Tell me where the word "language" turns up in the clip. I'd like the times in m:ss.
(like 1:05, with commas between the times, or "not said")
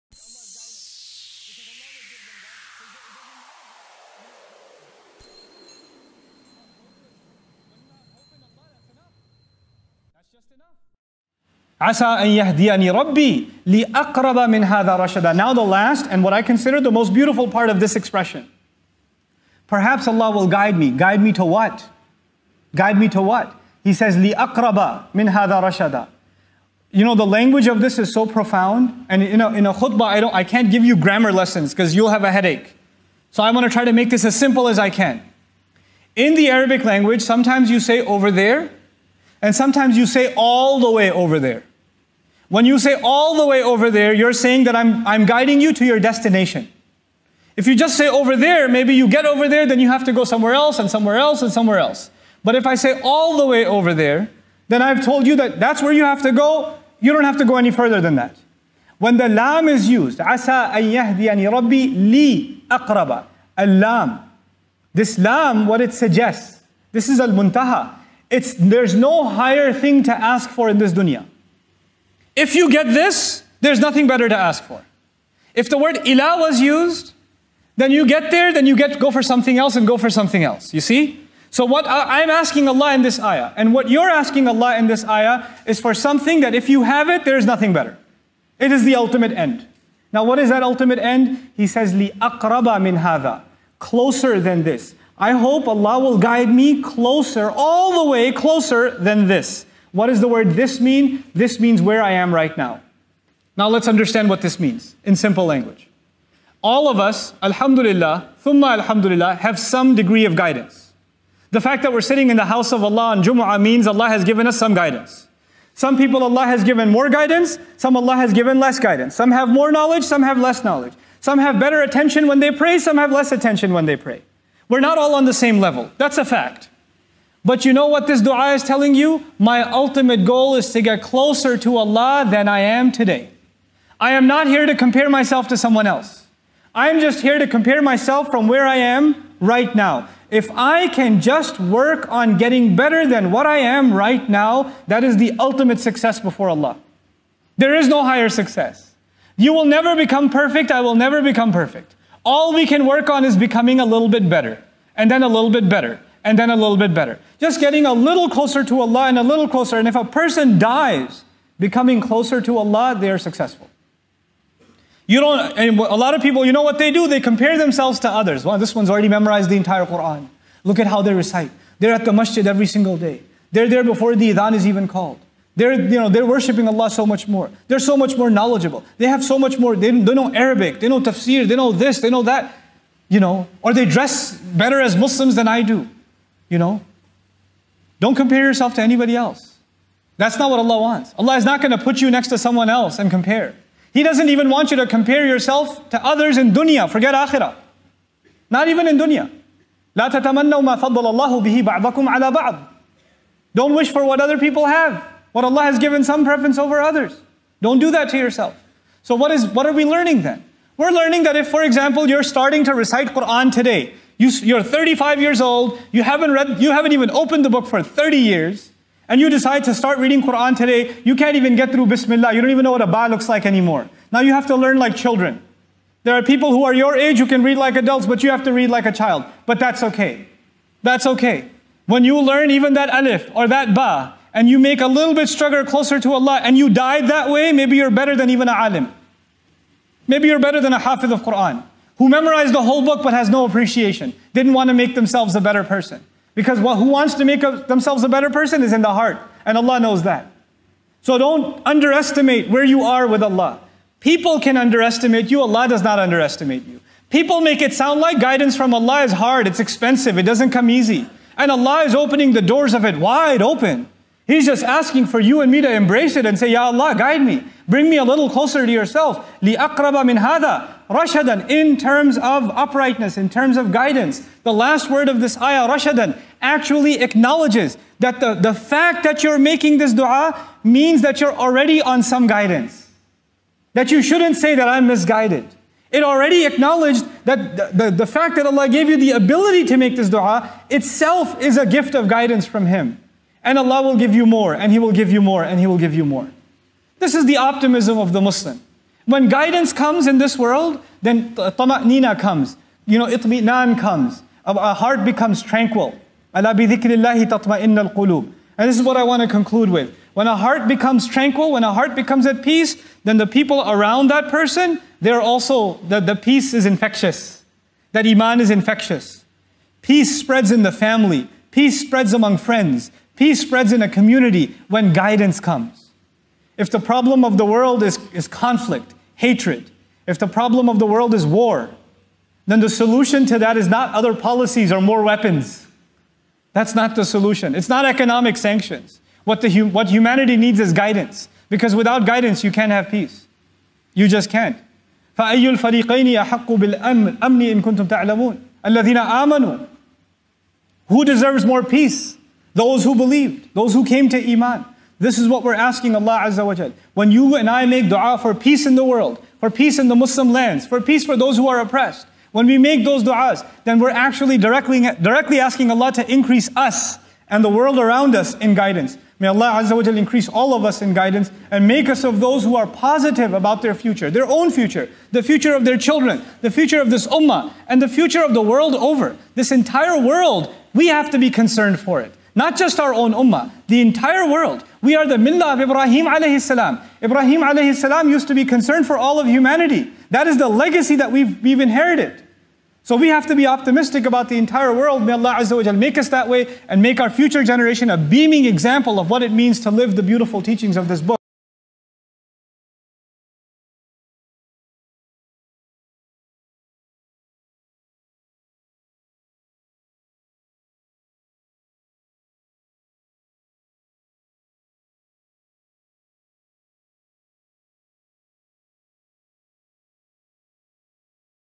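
0:27, 0:36, 1:45.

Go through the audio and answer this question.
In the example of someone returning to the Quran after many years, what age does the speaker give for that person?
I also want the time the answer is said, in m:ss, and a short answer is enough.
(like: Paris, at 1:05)
35, at 3:34.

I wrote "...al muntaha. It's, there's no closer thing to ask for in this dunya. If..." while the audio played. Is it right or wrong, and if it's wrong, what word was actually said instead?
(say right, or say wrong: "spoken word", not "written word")
wrong: "higher", not "closer".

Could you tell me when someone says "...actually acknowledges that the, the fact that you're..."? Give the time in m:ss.
4:36.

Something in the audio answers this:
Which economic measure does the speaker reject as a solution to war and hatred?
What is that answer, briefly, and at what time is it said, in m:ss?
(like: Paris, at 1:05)
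economic sanctions, at 5:37.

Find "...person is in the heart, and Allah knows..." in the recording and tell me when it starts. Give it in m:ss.
4:08.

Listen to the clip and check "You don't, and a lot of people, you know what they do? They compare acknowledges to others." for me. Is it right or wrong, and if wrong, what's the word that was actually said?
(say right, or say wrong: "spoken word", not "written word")
wrong: "themselves", not "acknowledges".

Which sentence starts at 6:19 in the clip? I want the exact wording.
This entire world, we have to be concerned for it.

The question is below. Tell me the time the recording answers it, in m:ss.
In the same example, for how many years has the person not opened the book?
3:37.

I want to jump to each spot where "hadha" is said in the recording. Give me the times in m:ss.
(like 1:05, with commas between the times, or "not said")
0:14, 0:25.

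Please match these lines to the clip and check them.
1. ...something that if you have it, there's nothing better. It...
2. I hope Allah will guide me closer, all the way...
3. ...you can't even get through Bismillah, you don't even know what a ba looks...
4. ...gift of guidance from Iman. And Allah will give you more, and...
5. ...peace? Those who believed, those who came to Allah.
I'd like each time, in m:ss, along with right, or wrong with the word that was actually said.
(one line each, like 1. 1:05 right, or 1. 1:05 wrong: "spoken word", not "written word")
1. 1:25 right
2. 1:35 right
3. 3:41 right
4. 4:51 wrong: "Him", not "Iman"
5. 5:51 wrong: "Iman", not "Allah".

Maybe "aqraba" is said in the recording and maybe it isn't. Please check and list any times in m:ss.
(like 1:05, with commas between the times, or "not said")
0:13, 0:24, 1:02.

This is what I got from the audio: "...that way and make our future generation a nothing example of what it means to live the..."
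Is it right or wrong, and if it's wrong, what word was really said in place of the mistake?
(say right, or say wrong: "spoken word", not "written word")
wrong: "beaming", not "nothing".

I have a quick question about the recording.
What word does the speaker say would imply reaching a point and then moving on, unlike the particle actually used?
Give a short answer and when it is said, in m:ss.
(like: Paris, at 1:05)
ila, at 1:16.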